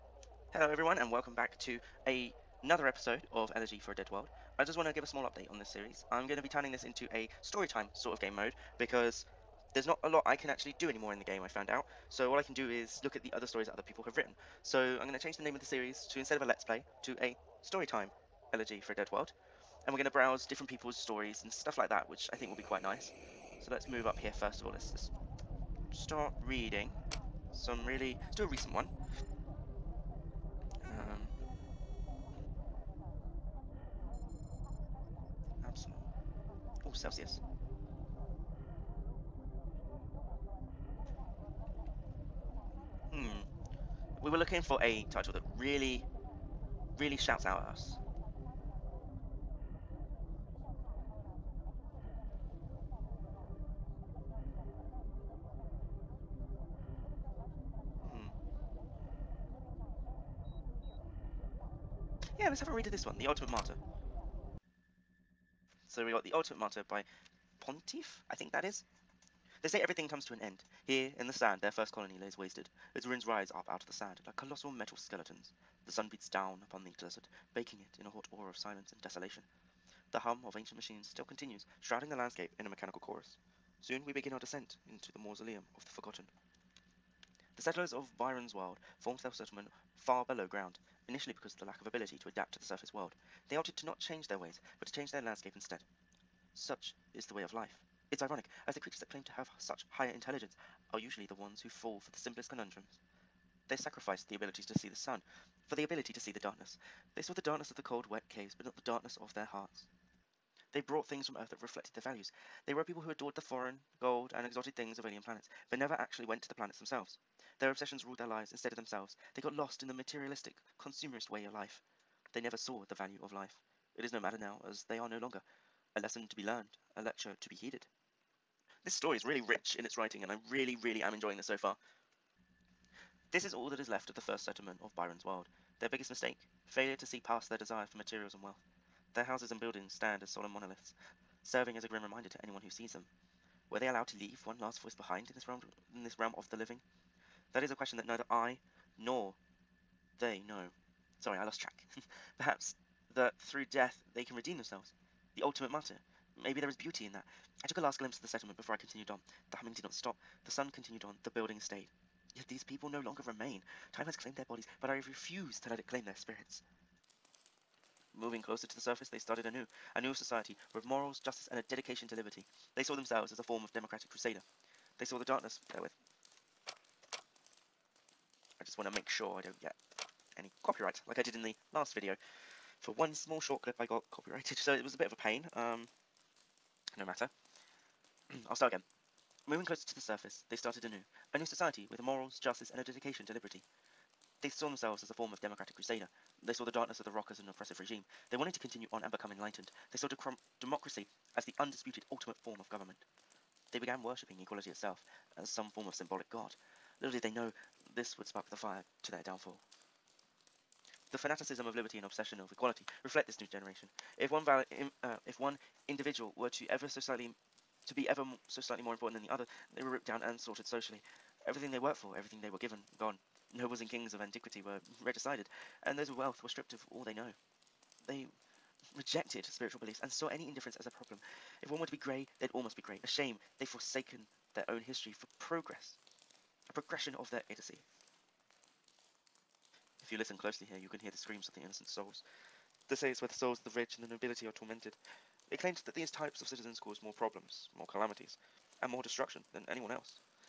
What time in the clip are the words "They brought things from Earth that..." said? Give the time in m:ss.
1:50.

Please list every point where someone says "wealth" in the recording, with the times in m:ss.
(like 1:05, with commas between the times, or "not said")
2:18, 3:46.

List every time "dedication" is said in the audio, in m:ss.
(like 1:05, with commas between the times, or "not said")
2:51, 3:12.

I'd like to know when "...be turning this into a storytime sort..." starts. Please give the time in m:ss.
0:06.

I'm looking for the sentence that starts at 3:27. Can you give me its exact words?
Little did they know this would spark the fire to their downfall.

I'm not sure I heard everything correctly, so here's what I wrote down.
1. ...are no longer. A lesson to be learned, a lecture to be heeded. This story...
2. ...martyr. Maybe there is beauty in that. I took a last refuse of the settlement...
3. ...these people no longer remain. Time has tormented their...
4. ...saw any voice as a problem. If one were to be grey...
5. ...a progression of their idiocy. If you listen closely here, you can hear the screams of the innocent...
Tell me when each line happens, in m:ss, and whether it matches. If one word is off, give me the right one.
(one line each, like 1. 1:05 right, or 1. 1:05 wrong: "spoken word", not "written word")
1. 2:04 right
2. 2:35 wrong: "glimpse", not "refuse"
3. 2:42 wrong: "claimed", not "tormented"
4. 3:50 wrong: "indifference", not "voice"
5. 3:56 right.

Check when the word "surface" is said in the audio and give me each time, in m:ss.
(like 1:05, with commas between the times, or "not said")
1:32, 2:48, 3:09.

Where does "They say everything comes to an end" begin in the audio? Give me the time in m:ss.
1:09.